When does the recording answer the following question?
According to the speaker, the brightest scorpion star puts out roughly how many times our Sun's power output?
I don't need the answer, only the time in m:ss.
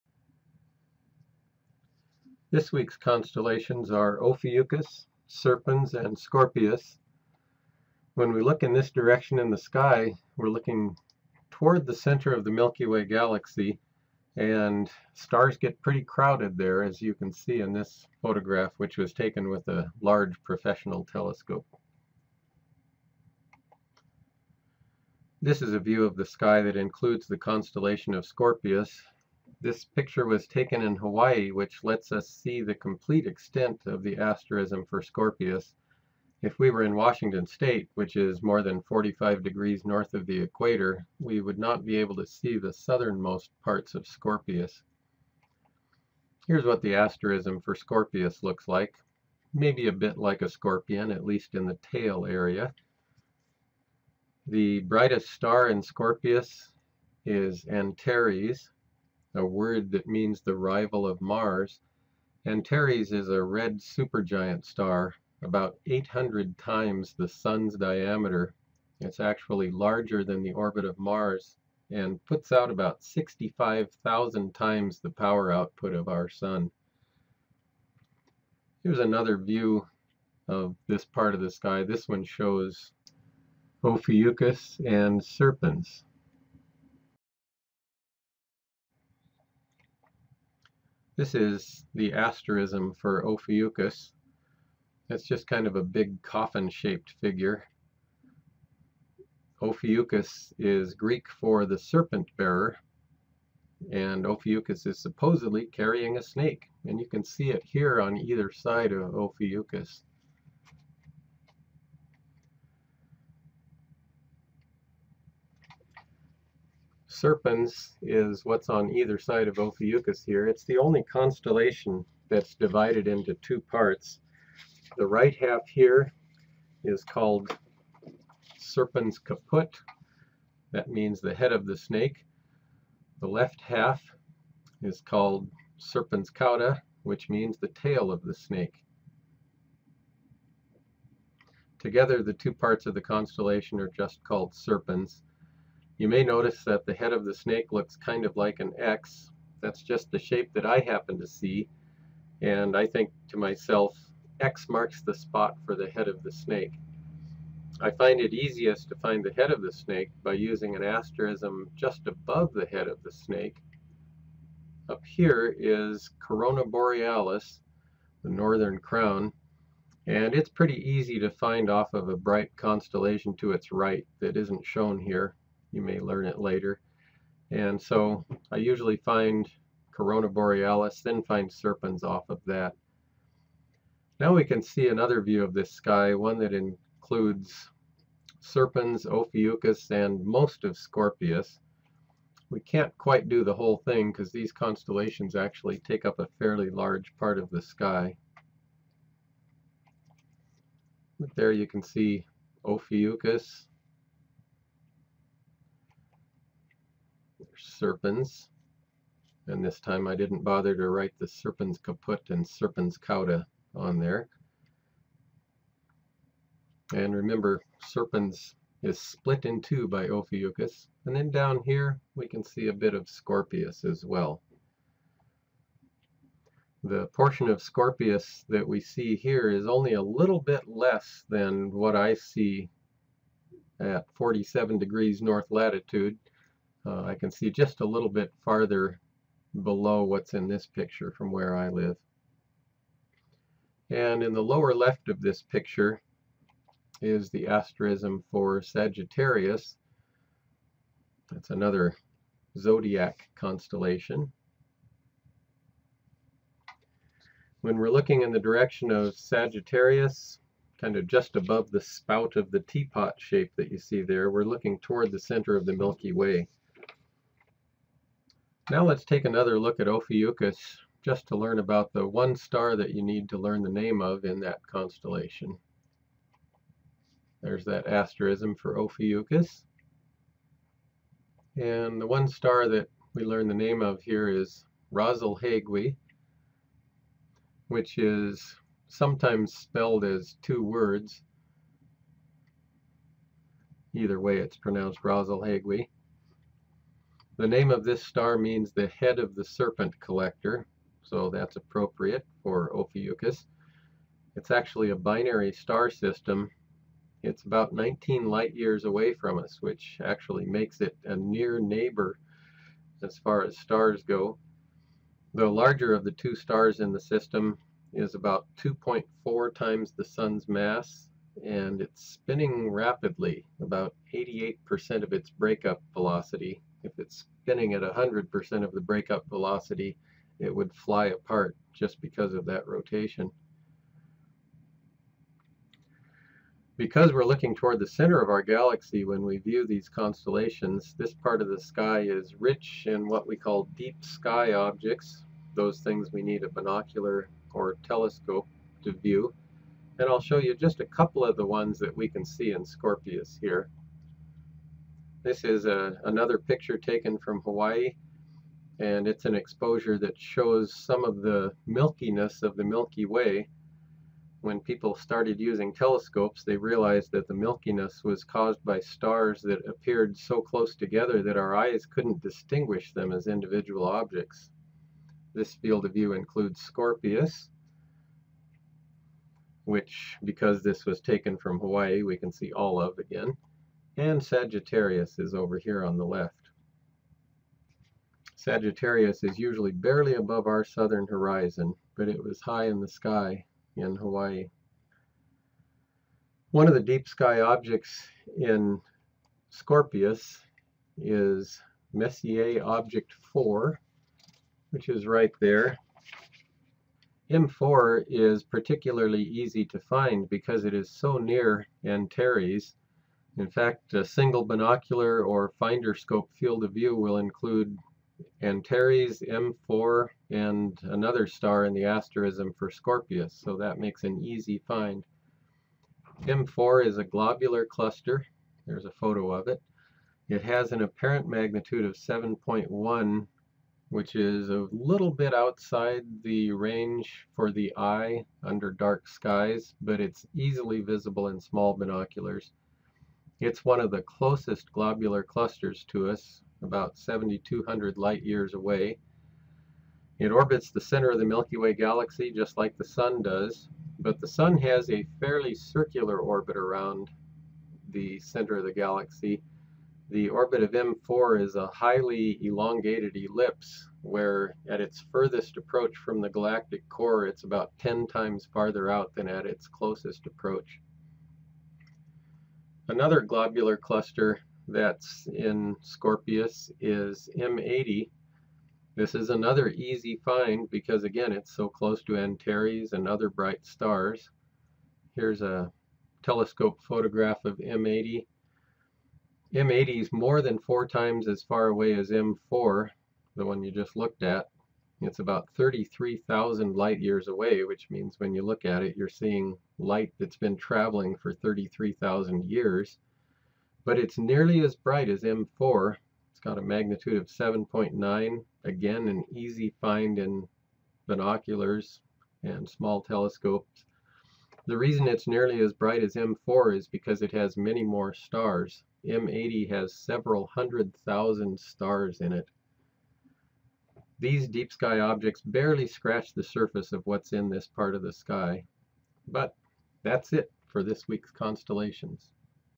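1:13.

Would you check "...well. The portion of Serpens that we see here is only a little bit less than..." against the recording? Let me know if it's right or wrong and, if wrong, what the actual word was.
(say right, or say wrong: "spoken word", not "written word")
wrong: "Scorpius", not "Serpens".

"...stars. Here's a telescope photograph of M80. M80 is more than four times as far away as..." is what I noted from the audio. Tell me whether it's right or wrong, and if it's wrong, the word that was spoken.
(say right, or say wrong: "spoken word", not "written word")
right.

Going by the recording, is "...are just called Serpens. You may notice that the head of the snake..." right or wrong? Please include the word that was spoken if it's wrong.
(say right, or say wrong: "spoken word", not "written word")
right.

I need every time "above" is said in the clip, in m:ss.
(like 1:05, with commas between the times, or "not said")
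2:42, 4:21, 6:30.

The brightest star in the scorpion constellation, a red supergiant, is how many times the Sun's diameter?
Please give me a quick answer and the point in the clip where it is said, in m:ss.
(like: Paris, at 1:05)
800, at 1:05.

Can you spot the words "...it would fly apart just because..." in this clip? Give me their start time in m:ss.
5:30.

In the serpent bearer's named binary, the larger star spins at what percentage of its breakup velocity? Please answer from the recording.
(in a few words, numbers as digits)
88%.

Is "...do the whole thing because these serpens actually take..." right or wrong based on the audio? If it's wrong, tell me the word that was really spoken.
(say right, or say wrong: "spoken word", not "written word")
wrong: "constellations", not "serpens".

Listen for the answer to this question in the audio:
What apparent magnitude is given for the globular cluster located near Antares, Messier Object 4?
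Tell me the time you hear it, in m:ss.
7:11.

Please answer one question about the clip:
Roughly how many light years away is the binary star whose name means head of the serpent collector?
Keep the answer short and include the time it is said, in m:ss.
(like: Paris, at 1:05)
19, at 5:07.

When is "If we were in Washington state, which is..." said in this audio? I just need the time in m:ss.
0:36.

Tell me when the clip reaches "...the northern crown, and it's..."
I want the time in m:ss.
2:48.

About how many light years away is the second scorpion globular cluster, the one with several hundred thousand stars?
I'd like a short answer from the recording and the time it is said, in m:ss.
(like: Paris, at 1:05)
33,000, at 8:15.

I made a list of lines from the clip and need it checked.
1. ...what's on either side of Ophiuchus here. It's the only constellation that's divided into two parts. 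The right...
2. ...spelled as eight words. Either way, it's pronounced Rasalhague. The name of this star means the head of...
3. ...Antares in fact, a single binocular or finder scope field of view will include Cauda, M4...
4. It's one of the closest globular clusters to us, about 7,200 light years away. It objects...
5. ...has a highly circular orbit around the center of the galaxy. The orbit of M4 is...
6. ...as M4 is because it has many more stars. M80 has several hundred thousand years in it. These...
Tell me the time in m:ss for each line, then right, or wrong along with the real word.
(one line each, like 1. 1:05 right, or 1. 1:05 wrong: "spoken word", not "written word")
1. 1:58 right
2. 4:49 wrong: "two", not "eight"
3. 6:51 wrong: "Antares", not "Cauda"
4. 7:23 wrong: "orbits", not "objects"
5. 7:34 wrong: "fairly", not "highly"
6. 8:36 wrong: "stars", not "years".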